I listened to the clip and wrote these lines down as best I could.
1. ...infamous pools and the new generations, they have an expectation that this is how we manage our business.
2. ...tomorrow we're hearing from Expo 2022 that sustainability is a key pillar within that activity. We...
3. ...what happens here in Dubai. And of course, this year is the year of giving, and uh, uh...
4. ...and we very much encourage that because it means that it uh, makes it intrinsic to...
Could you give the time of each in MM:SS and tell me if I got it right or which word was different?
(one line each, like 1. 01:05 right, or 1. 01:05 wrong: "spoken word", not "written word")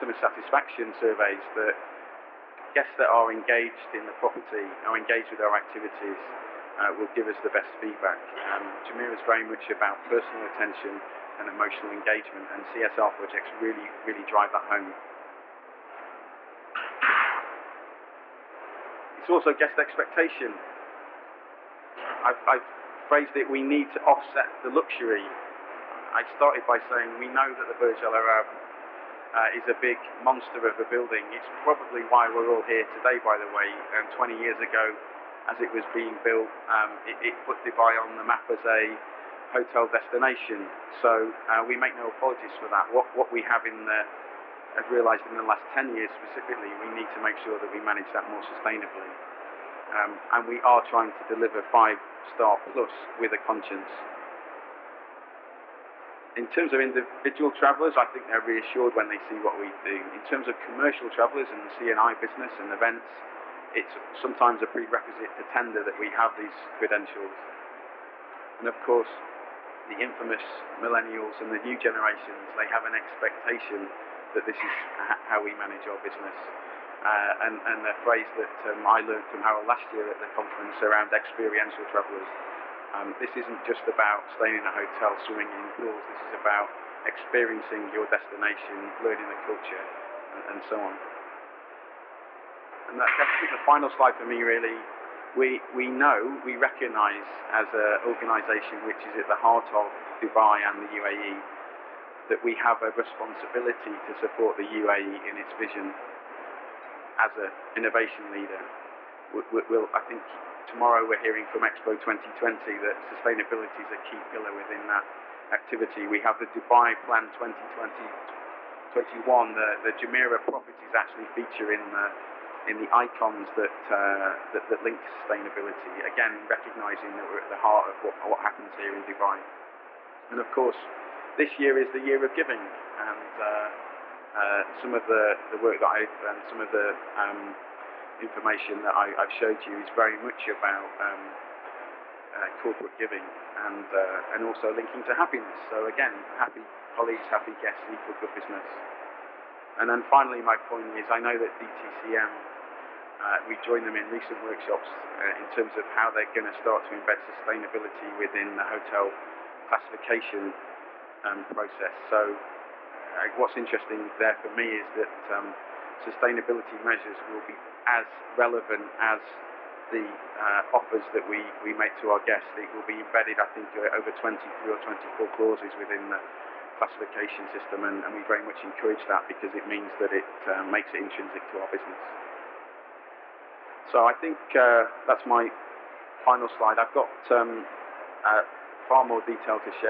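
1. 01:09 wrong: "millennials", not "pools"
2. 01:50 wrong: "2020", not "2022"
3. 02:08 right
4. 02:58 right.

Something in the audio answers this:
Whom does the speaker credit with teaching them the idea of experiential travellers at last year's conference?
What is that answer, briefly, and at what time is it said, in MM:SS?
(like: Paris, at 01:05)
Harold, at 01:19.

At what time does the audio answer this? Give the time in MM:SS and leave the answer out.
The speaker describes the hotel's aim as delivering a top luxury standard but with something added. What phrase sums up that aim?
00:51.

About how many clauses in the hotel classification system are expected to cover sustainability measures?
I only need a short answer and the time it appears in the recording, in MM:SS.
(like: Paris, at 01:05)
23 or 24, at 02:54.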